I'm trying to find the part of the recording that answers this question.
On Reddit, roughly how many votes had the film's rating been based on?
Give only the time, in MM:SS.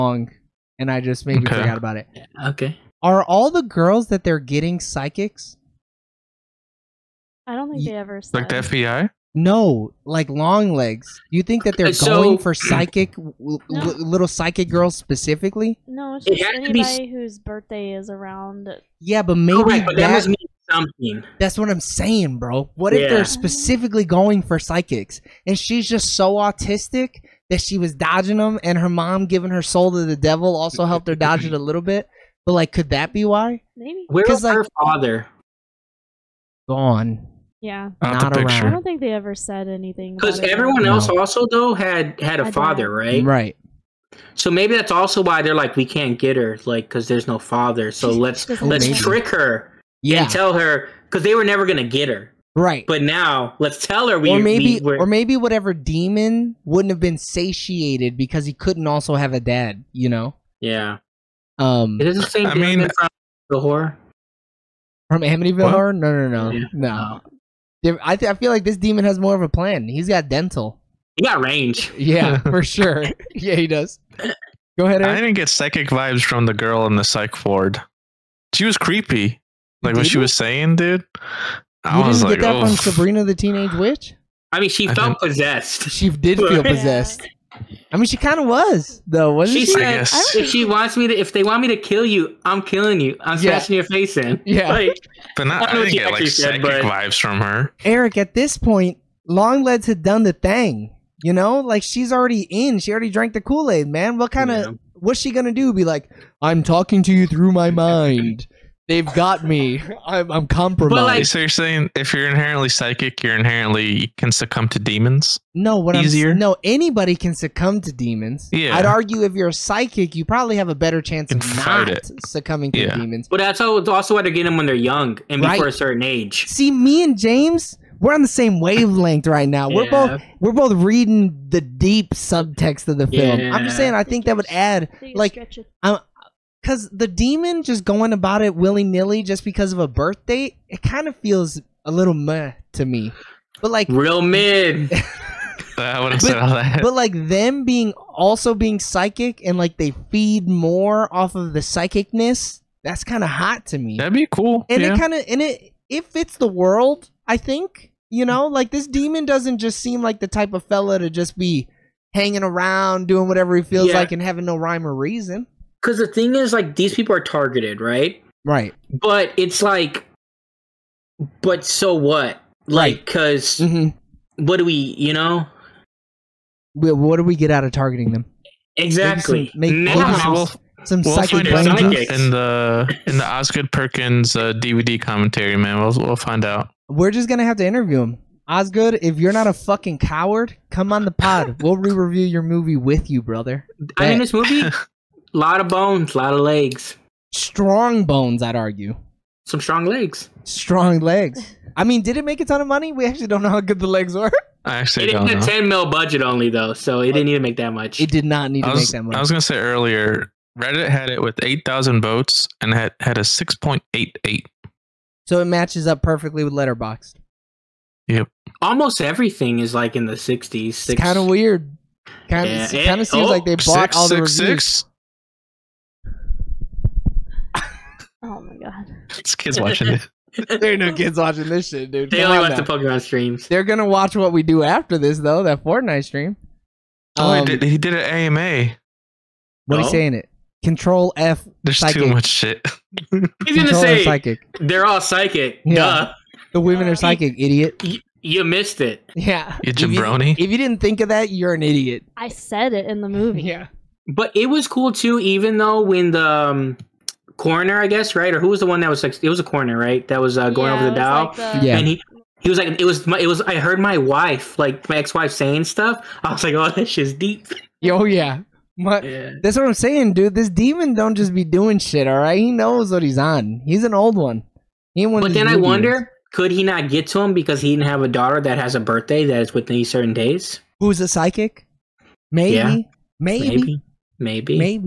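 03:31.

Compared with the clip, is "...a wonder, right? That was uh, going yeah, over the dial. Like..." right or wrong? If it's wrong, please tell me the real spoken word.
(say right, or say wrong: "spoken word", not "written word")
wrong: "coroner", not "wonder".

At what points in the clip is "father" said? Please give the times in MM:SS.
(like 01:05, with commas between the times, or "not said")
00:34, 00:42, 00:47.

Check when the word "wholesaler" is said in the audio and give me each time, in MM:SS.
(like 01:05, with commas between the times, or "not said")
not said.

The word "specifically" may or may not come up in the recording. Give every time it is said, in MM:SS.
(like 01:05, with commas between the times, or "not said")
00:14, 00:23.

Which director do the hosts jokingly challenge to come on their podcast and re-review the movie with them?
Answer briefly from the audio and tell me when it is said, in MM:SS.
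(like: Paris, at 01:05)
Osgood Perkins, at 03:03.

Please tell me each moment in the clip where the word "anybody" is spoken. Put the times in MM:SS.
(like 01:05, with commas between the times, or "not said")
00:16, 01:56.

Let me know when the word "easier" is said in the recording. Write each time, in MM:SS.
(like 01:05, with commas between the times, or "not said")
01:55.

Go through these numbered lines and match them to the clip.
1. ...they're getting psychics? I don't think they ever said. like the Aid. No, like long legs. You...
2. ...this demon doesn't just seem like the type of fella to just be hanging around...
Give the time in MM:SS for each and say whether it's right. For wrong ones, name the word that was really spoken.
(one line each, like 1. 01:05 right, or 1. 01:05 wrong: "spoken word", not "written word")
1. 00:04 wrong: "FBI", not "Aid"
2. 02:38 right.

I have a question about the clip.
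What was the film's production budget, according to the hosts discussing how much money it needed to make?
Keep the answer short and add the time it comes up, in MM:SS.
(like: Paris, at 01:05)
$10 million, at 03:25.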